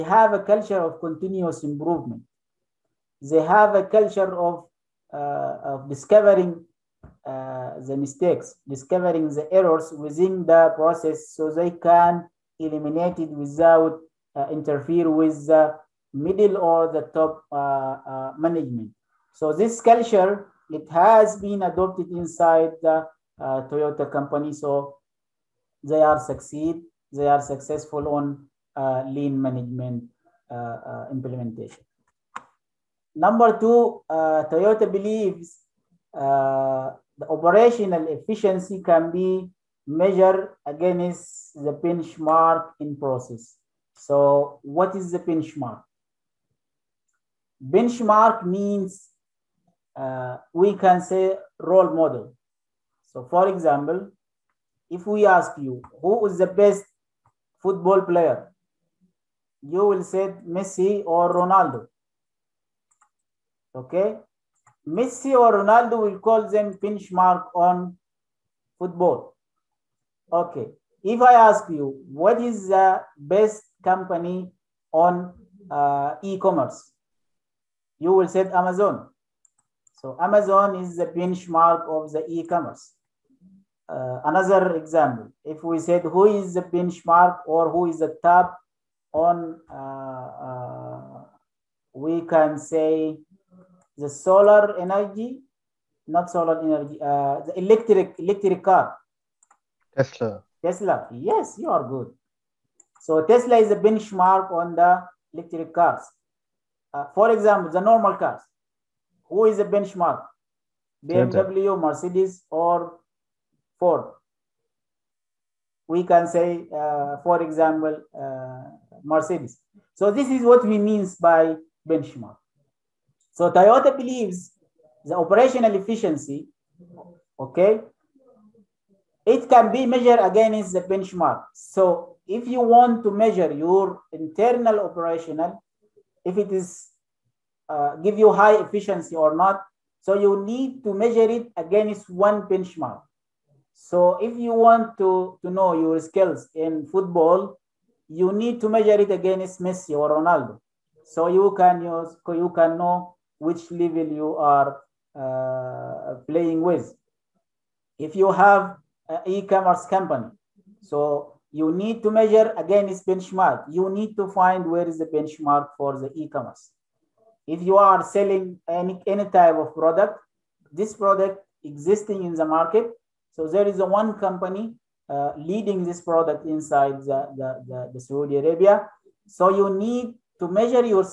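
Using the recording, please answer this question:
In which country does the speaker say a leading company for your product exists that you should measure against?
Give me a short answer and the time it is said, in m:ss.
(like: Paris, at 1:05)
Saudi Arabia, at 2:57.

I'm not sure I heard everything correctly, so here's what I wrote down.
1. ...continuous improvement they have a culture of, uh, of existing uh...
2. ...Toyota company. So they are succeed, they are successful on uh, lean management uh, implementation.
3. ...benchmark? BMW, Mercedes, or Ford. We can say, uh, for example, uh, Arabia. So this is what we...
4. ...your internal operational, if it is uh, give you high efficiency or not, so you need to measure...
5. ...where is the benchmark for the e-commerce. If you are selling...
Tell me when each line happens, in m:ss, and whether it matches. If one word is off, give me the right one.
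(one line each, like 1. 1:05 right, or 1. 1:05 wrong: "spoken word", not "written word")
1. 0:00 wrong: "discovering", not "existing"
2. 0:23 right
3. 1:49 wrong: "Mercedes", not "Arabia"
4. 2:13 right
5. 2:44 right.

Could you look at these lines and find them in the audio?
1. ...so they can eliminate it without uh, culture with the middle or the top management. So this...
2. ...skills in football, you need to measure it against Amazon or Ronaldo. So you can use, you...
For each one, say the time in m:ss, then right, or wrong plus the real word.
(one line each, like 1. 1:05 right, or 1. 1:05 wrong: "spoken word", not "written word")
1. 0:11 wrong: "interfere", not "culture"
2. 2:26 wrong: "Messi", not "Amazon".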